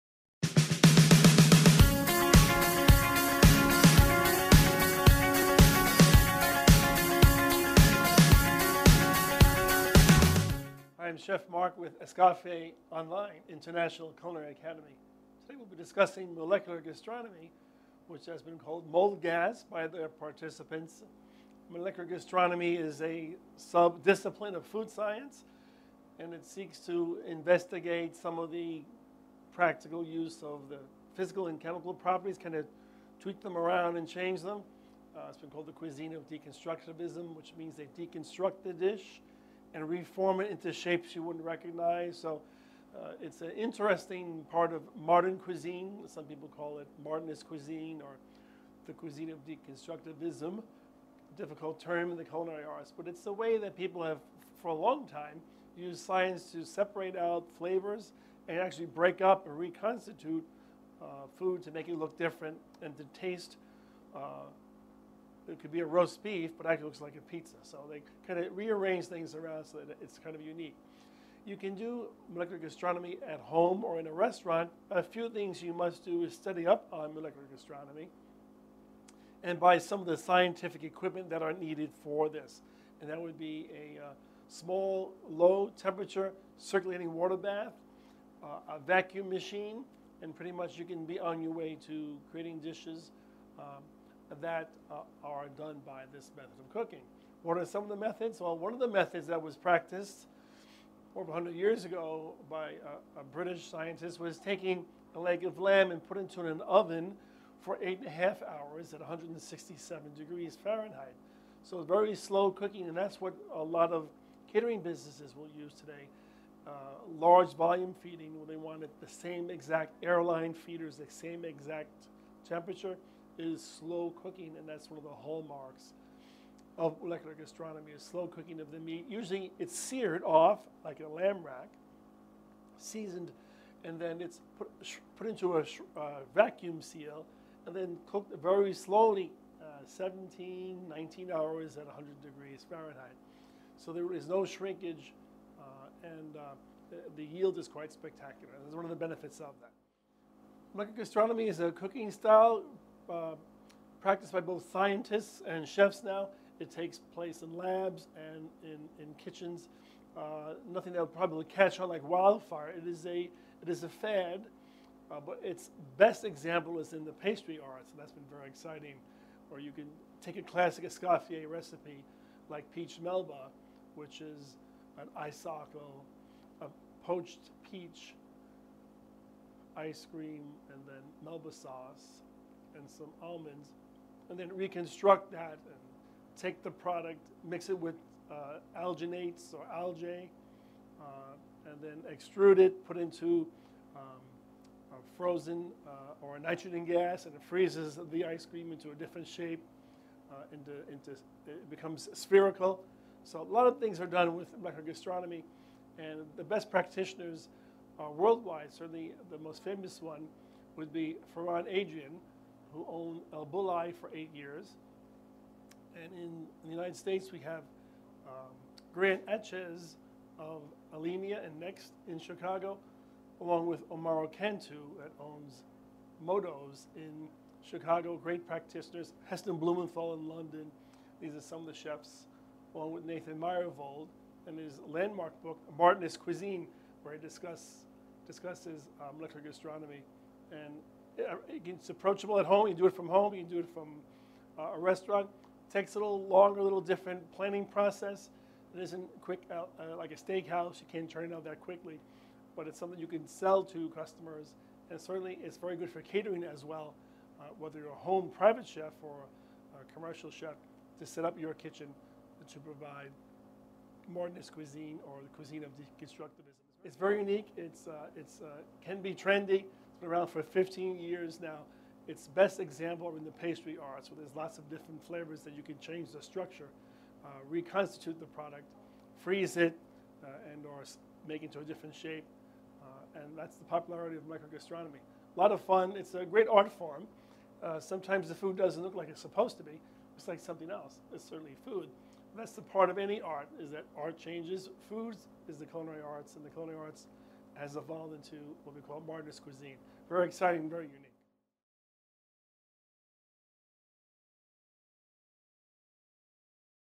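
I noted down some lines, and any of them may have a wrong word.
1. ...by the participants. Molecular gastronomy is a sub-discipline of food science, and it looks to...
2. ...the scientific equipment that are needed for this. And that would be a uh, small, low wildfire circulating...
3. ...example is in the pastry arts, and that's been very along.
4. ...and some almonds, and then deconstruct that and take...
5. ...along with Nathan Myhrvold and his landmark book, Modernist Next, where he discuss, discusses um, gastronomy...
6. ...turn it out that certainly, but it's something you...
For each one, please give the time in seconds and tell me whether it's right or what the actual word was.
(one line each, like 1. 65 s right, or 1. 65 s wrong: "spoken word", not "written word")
1. 19 s wrong: "seeks", not "looks"
2. 80 s wrong: "temperature", not "wildfire"
3. 166 s wrong: "exciting", not "along"
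4. 182 s wrong: "reconstruct", not "deconstruct"
5. 232 s wrong: "Cuisine", not "Next"
6. 251 s wrong: "quickly", not "certainly".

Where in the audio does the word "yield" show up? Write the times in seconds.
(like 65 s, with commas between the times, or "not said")
147 s.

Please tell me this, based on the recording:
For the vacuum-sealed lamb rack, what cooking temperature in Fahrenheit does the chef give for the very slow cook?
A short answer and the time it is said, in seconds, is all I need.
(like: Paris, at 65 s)
100 degrees Fahrenheit, at 141 s.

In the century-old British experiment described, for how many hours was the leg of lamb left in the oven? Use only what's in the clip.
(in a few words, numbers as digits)
8.5 hours.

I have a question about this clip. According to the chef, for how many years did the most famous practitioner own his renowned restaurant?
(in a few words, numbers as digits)
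8 years.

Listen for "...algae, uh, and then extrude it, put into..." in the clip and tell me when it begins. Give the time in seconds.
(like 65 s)
189 s.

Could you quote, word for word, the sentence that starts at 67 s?
So they kind of rearrange things around so that it's kind of unique.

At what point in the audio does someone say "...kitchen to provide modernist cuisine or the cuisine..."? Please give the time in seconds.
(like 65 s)
261 s.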